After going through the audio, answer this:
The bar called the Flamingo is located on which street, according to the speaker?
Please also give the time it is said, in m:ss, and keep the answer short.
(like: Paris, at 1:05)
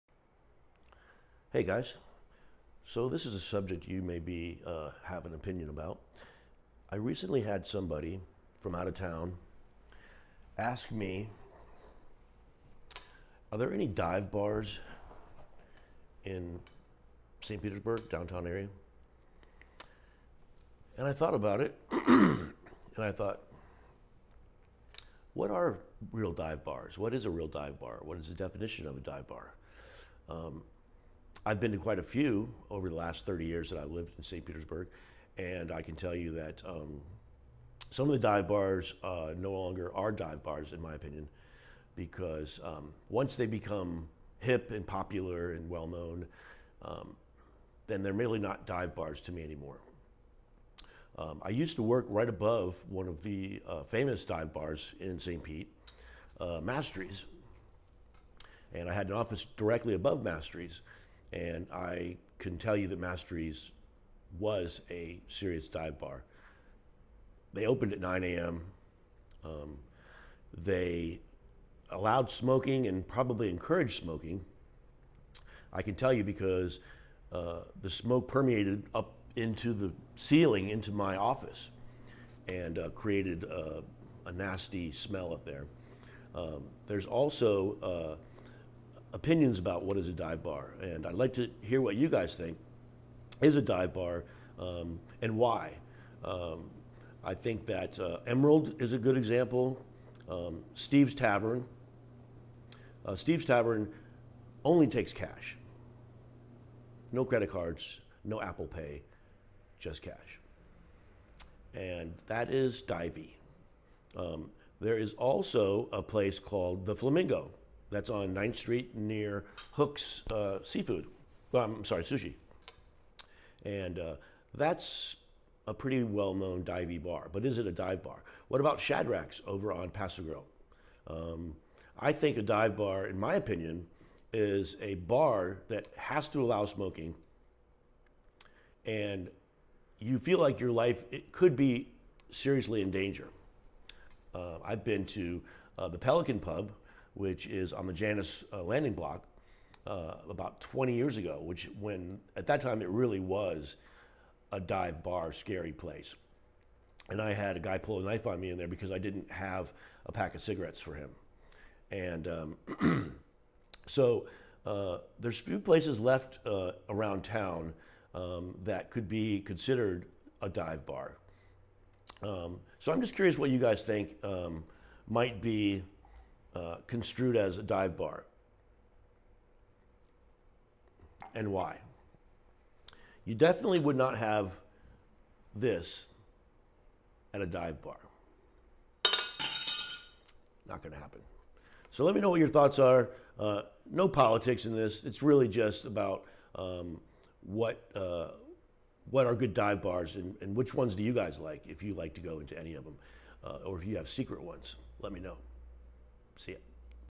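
9th Street, at 1:58.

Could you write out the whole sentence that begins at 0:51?
Um, I used to work right above one of the uh, famous dive bars in St.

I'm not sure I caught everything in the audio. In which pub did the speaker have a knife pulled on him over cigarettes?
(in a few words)
Pelican Pub.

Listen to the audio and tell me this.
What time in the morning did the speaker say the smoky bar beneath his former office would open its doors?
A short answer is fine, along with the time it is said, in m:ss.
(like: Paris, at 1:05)
9 a.m., at 1:07.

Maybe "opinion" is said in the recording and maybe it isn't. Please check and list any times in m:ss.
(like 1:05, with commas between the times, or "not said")
0:05, 0:40, 1:29, 2:13.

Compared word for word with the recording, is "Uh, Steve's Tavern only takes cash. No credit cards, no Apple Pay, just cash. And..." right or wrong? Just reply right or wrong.
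right.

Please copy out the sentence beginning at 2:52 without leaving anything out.
Um, so I'm just curious what you guys think um, might be uh, construed as a dive bar?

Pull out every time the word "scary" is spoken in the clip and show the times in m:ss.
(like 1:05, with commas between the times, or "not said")
2:35.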